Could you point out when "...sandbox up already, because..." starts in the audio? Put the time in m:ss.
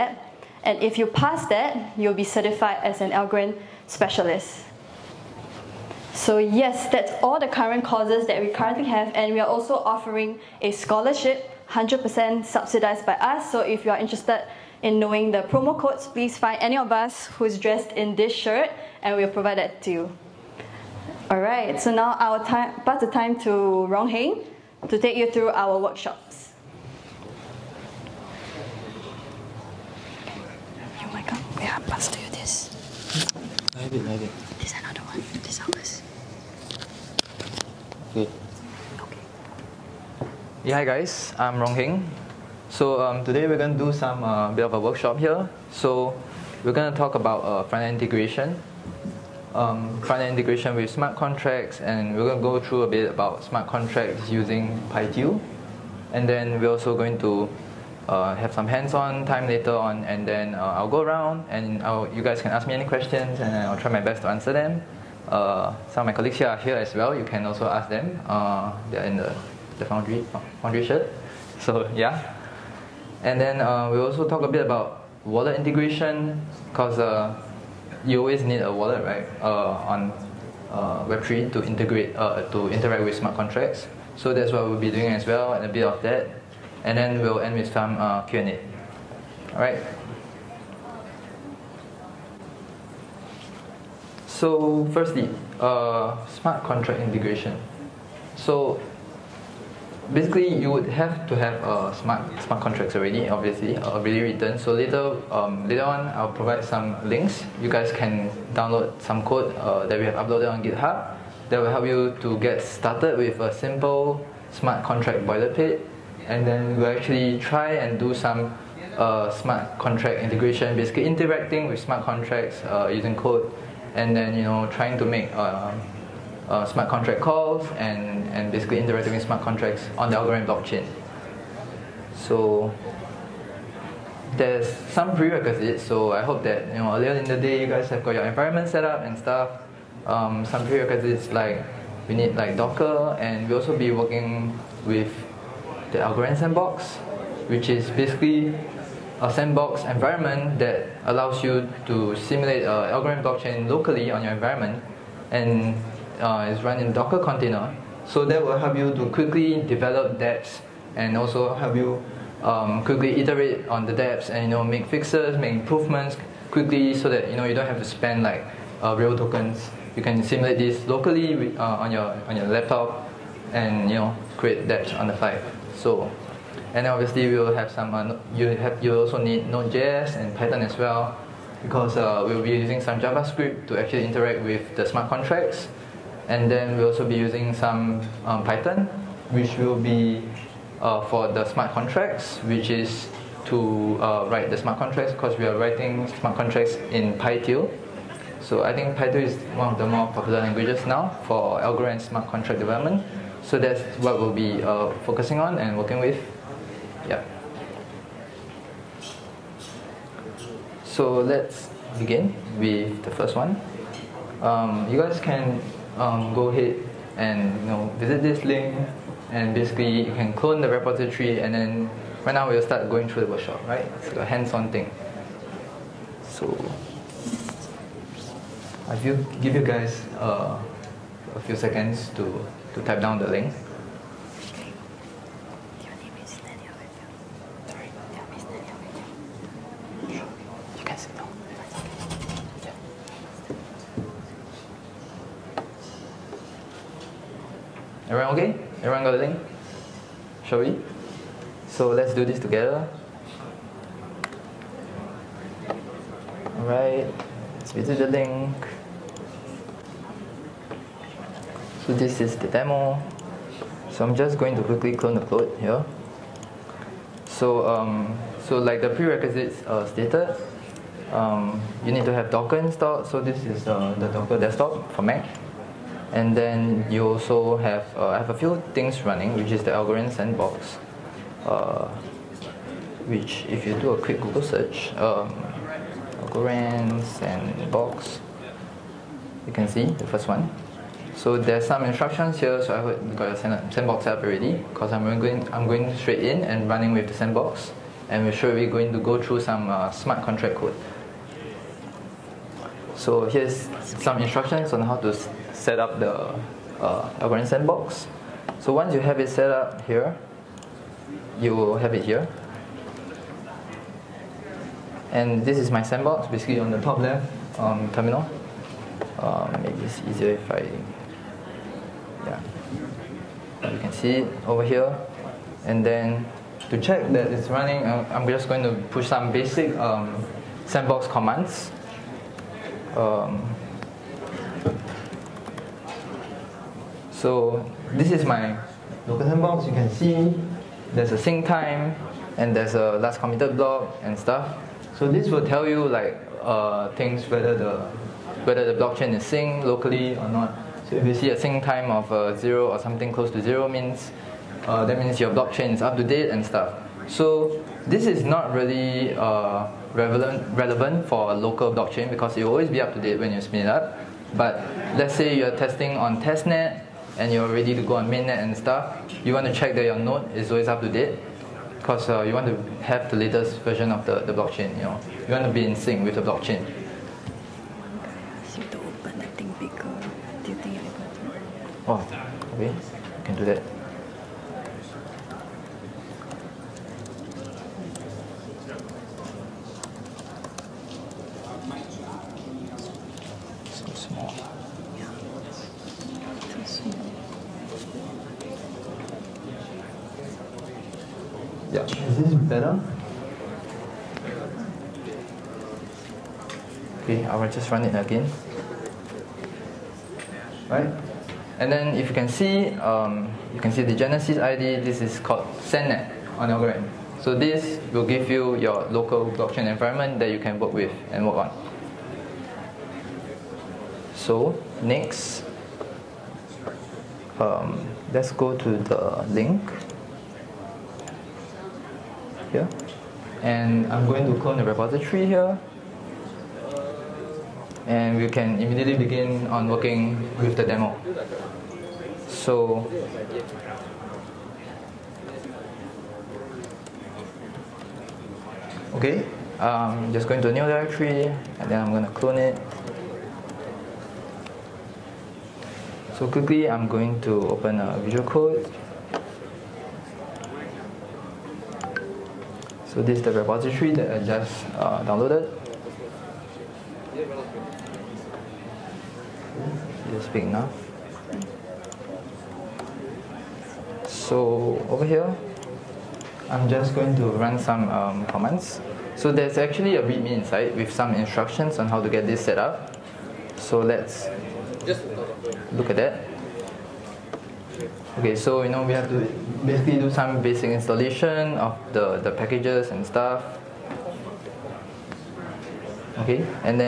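4:53.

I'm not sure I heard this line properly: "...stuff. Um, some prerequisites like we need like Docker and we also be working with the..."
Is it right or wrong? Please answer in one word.
right.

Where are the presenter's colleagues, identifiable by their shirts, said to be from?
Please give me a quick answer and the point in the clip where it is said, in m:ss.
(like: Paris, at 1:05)
the Foundry, at 1:10.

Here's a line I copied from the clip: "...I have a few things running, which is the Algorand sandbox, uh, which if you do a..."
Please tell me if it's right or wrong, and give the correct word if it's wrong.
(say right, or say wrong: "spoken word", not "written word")
right.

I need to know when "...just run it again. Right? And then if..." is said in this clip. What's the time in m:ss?
6:47.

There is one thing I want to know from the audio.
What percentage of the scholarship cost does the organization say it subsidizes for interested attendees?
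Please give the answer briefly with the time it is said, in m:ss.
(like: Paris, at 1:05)
100%, at 0:11.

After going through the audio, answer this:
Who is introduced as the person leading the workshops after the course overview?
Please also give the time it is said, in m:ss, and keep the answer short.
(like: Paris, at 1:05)
Rong Heng, at 0:23.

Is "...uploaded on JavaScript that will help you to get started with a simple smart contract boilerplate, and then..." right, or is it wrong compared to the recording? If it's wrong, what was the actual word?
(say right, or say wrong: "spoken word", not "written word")
wrong: "GitHub", not "JavaScript".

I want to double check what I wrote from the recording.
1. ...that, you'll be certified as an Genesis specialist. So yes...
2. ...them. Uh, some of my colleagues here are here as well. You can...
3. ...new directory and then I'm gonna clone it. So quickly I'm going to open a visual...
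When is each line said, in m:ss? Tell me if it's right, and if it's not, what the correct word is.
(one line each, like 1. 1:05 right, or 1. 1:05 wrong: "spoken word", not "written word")
1. 0:01 wrong: "Algorand", not "Genesis"
2. 1:04 right
3. 7:30 right.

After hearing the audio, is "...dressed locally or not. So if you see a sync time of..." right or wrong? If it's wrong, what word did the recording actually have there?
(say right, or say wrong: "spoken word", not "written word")
wrong: "synced", not "dressed".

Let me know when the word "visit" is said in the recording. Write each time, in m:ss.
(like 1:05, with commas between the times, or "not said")
3:37, 4:17.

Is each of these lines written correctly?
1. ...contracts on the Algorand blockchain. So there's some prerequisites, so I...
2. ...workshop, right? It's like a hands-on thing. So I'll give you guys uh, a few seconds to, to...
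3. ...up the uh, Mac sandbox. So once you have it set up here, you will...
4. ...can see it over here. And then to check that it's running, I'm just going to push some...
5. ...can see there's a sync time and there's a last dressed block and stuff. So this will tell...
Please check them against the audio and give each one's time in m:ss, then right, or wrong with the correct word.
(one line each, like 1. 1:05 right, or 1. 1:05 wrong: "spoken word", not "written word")
1. 2:09 right
2. 3:43 right
3. 5:05 wrong: "Algorand", not "Mac"
4. 5:23 right
5. 5:39 wrong: "committed", not "dressed".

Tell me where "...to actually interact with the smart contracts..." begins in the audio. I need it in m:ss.
3:03.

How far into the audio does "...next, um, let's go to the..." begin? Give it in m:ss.
7:04.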